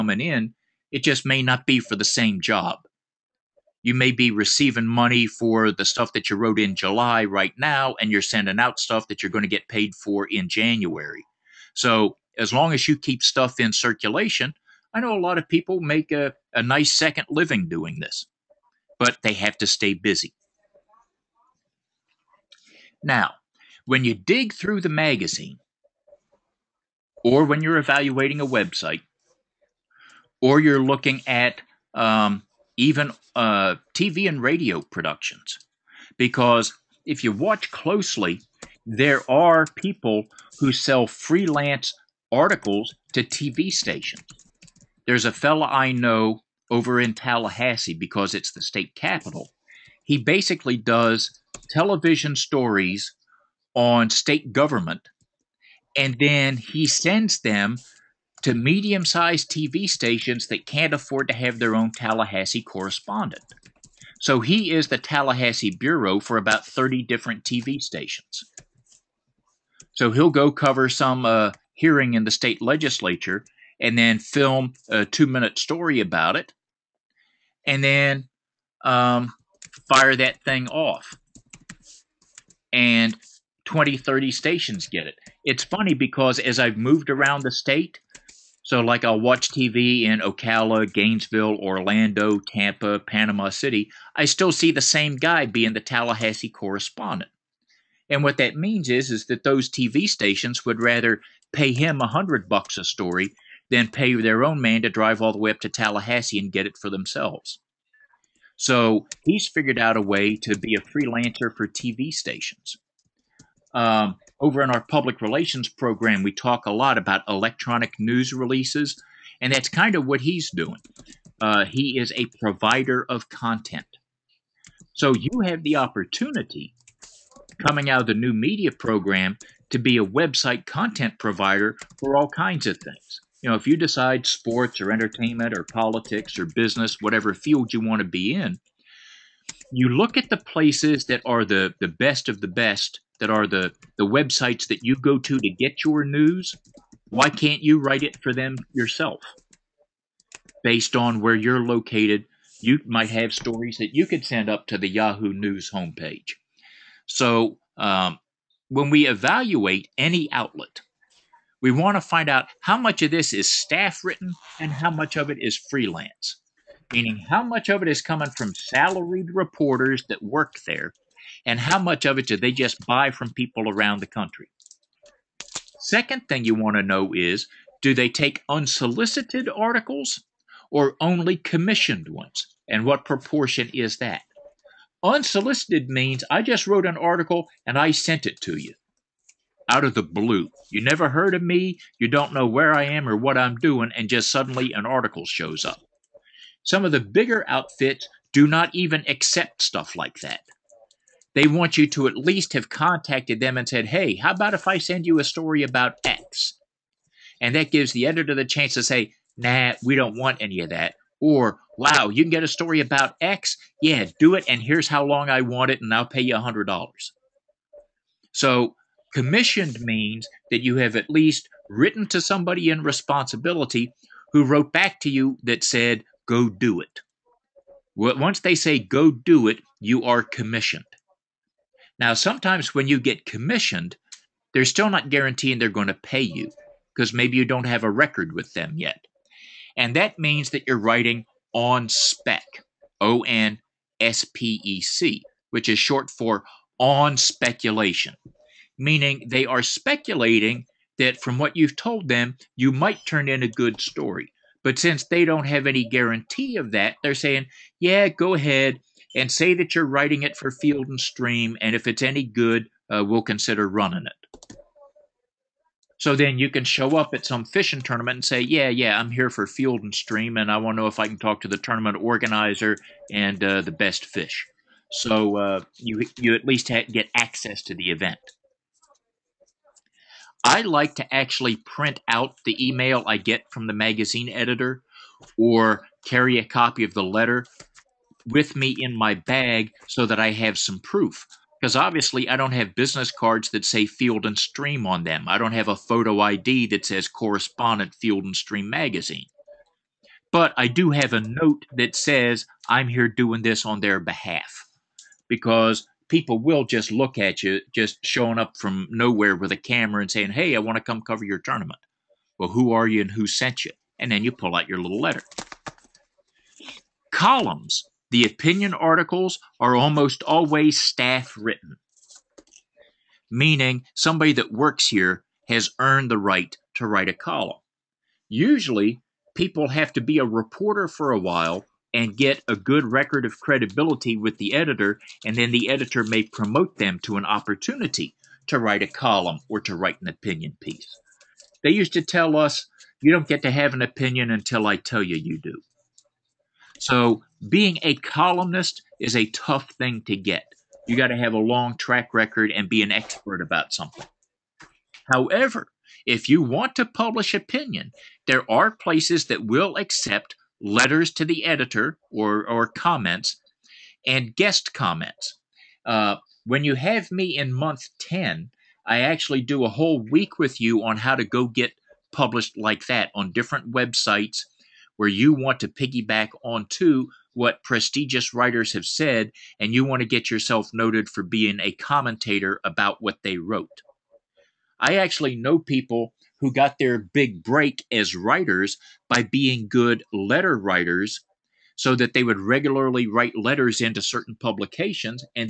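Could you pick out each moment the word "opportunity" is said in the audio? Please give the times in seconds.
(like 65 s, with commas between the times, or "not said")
125 s, 337 s.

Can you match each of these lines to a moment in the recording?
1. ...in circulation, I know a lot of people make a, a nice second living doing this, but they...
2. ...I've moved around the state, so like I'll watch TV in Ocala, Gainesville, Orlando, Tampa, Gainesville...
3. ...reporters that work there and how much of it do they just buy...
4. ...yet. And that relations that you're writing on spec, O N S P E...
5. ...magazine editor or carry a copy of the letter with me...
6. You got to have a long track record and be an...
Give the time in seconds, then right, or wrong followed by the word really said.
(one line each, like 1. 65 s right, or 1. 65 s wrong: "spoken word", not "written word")
1. 13 s right
2. 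86 s wrong: "Panama", not "Gainesville"
3. 169 s right
4. 238 s wrong: "means", not "relations"
5. 283 s right
6. 350 s right.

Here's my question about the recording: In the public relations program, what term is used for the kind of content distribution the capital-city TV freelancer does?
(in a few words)
electronic news releases.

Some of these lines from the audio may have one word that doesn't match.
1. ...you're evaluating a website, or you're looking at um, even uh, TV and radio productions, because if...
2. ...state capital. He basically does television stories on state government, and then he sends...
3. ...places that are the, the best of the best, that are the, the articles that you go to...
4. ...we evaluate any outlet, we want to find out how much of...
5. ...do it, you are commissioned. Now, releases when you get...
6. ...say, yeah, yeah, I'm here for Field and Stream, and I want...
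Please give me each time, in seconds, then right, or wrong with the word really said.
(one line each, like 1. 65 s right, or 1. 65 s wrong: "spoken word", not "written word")
1. 27 s right
2. 48 s right
3. 140 s wrong: "websites", not "articles"
4. 158 s right
5. 229 s wrong: "sometimes", not "releases"
6. 268 s right.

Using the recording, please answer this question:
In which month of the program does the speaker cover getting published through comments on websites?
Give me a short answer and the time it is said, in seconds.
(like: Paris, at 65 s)
month 10, at 367 s.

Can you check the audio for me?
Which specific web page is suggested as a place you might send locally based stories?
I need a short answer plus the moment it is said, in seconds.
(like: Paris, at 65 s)
Yahoo News homepage, at 154 s.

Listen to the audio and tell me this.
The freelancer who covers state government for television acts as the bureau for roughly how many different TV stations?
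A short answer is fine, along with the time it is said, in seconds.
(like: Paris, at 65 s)
30, at 66 s.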